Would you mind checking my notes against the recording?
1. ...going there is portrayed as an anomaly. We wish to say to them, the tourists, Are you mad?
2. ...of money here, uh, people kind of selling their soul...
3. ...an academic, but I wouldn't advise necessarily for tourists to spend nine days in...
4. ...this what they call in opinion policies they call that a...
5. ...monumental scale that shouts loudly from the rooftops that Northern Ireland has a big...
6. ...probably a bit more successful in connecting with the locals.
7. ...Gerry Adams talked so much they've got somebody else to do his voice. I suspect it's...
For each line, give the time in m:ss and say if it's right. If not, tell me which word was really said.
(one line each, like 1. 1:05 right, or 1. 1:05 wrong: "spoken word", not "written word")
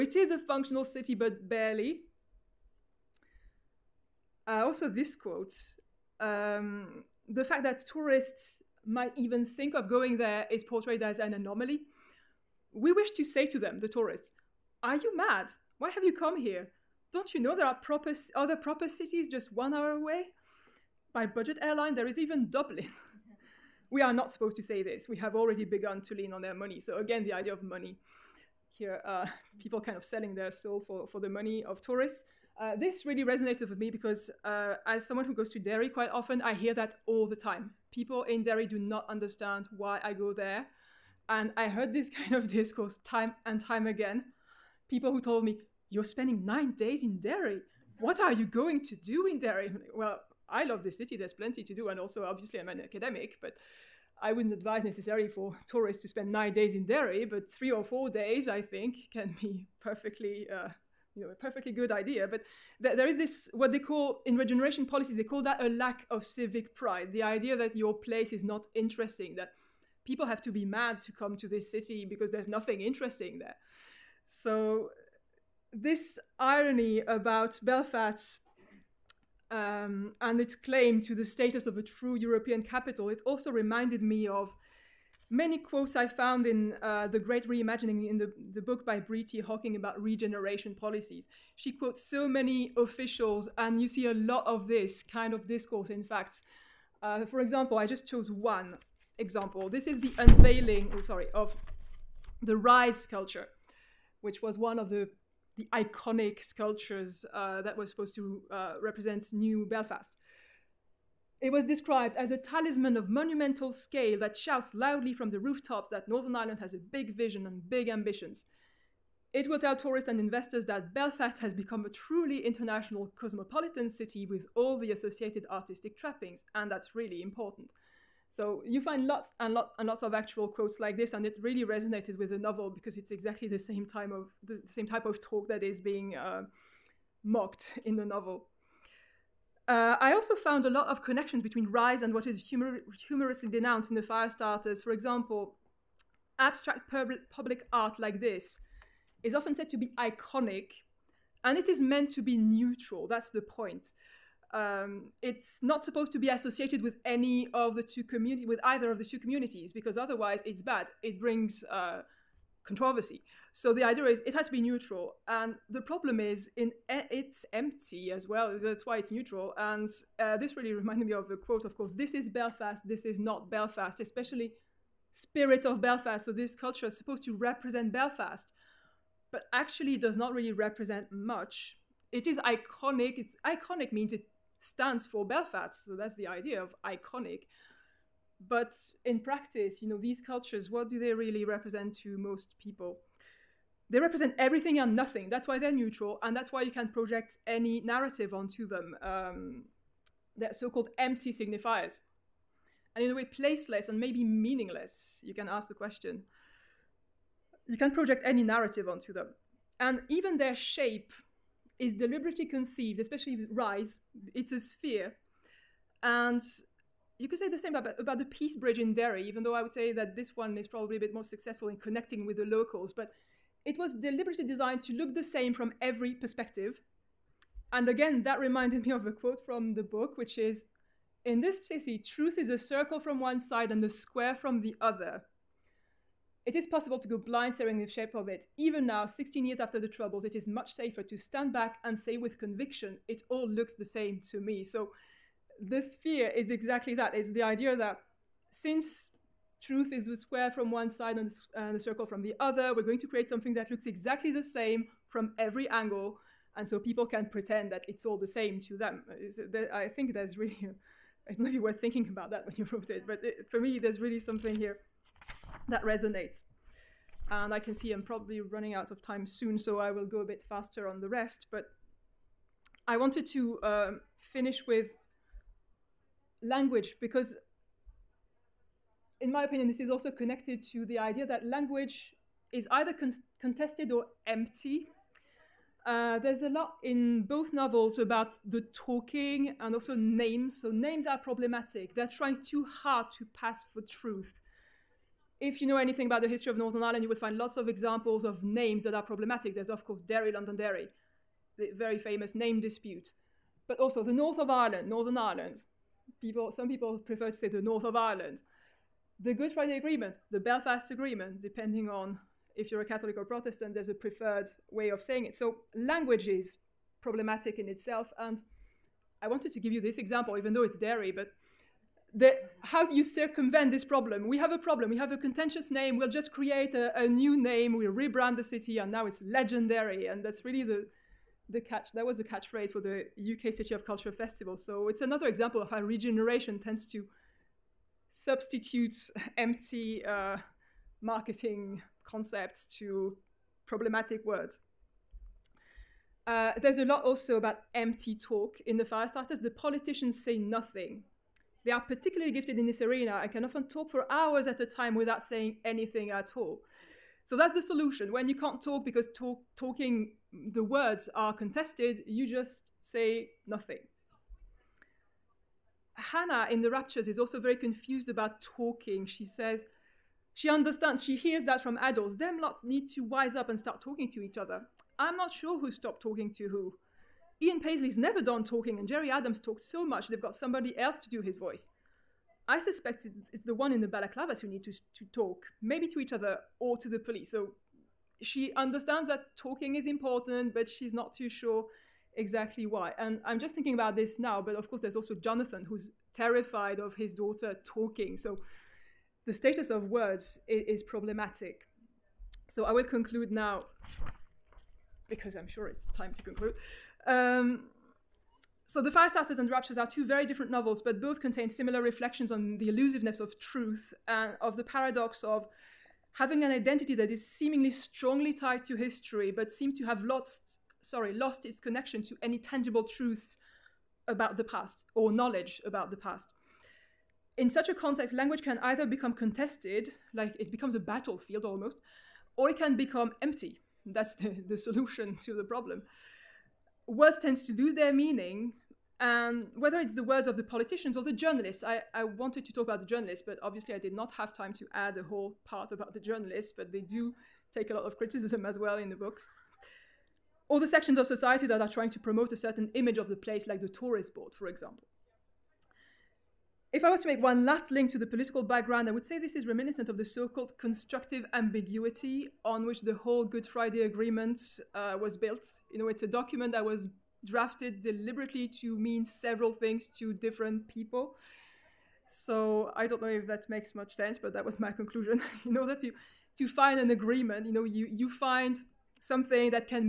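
1. 0:09 right
2. 0:27 right
3. 0:52 right
4. 1:03 wrong: "regeneration", not "opinion"
5. 1:53 right
6. 3:40 right
7. 6:18 right.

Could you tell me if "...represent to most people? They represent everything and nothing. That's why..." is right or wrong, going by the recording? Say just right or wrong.
right.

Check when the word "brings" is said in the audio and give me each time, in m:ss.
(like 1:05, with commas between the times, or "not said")
2:41.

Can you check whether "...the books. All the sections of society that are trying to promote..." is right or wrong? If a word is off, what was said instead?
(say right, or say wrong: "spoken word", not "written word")
right.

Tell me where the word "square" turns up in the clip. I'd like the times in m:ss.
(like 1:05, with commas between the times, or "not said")
3:53, 4:10.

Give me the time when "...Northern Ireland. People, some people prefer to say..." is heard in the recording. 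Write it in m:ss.
5:04.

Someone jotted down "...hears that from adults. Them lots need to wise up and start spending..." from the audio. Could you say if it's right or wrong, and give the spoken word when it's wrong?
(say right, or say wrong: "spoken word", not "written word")
wrong: "talking", not "spending".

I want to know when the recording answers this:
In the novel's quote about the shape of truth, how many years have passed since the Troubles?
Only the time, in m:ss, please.
3:59.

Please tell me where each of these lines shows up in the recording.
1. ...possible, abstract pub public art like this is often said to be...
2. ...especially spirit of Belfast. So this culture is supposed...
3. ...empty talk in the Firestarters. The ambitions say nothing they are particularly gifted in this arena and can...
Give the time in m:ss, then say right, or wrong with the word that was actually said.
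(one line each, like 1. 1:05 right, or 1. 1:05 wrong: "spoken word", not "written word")
1. 2:24 wrong: "example", not "possible"
2. 2:53 right
3. 5:47 wrong: "politicians", not "ambitions".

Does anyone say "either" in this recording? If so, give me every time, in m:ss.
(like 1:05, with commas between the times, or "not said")
2:38, 4:42, 7:08.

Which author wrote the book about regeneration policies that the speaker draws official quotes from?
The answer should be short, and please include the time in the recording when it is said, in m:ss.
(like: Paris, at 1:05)
Bree T. Hocking, at 1:28.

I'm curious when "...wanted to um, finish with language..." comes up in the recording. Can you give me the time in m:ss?
4:32.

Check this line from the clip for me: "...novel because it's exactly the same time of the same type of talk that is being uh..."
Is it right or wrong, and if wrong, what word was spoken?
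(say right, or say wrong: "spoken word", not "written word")
right.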